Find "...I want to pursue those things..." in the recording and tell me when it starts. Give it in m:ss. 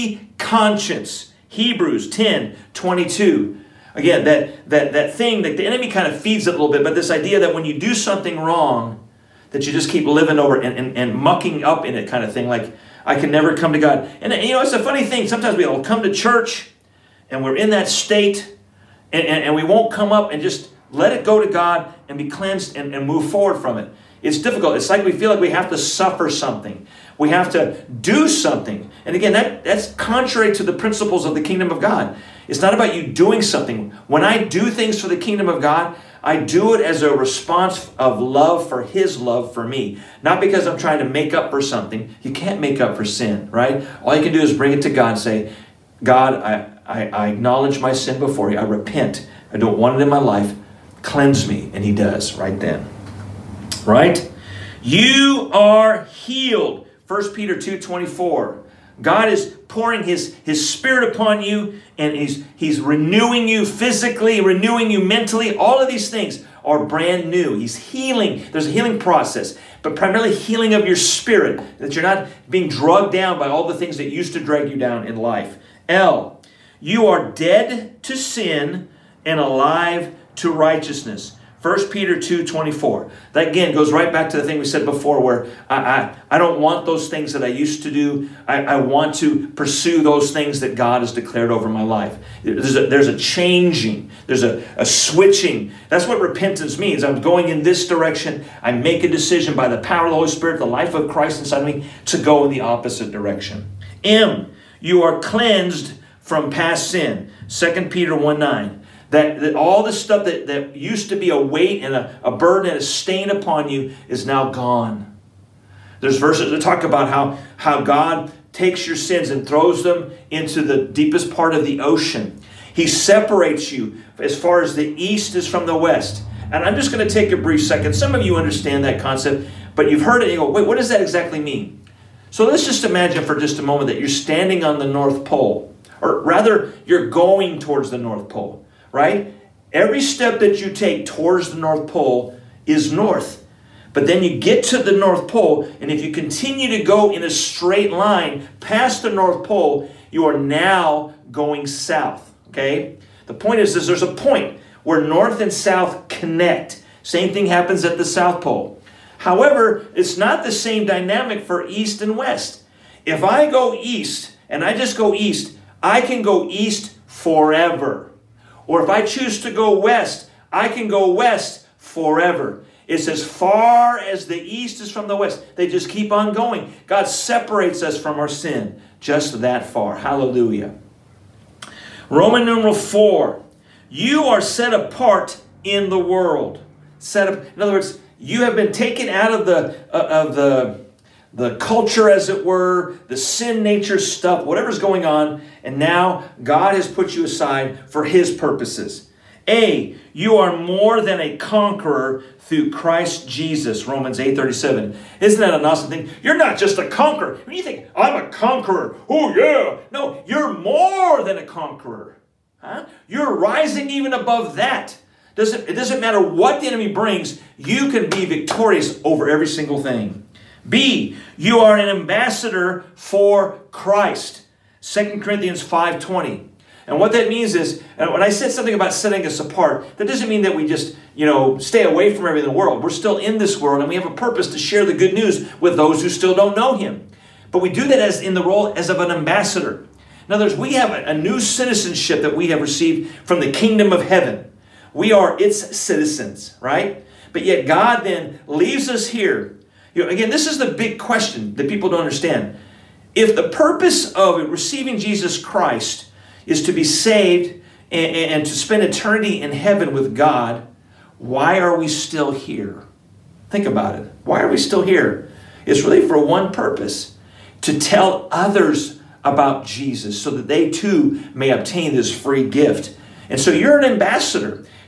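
1:28.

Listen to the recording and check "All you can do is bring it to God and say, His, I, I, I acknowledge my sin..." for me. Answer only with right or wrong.
wrong.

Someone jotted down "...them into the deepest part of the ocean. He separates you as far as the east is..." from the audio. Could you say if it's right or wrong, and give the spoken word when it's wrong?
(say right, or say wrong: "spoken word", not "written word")
right.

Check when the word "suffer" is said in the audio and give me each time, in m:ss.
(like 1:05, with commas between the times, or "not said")
0:25.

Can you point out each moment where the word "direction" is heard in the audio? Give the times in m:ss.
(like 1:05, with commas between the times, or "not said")
1:37, 1:43.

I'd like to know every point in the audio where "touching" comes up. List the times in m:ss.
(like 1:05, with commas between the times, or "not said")
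not said.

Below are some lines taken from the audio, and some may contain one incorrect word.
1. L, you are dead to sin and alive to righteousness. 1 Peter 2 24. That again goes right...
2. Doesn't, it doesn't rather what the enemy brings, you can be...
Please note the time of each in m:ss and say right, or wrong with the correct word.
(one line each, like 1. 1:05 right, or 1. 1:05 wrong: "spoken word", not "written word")
1. 1:15 right
2. 3:35 wrong: "matter", not "rather".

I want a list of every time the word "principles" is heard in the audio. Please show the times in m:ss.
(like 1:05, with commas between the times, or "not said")
0:30.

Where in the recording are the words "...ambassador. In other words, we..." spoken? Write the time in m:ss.
3:59.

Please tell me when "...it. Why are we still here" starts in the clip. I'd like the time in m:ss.
4:23.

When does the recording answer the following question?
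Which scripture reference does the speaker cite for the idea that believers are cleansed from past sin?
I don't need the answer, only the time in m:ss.
1:47.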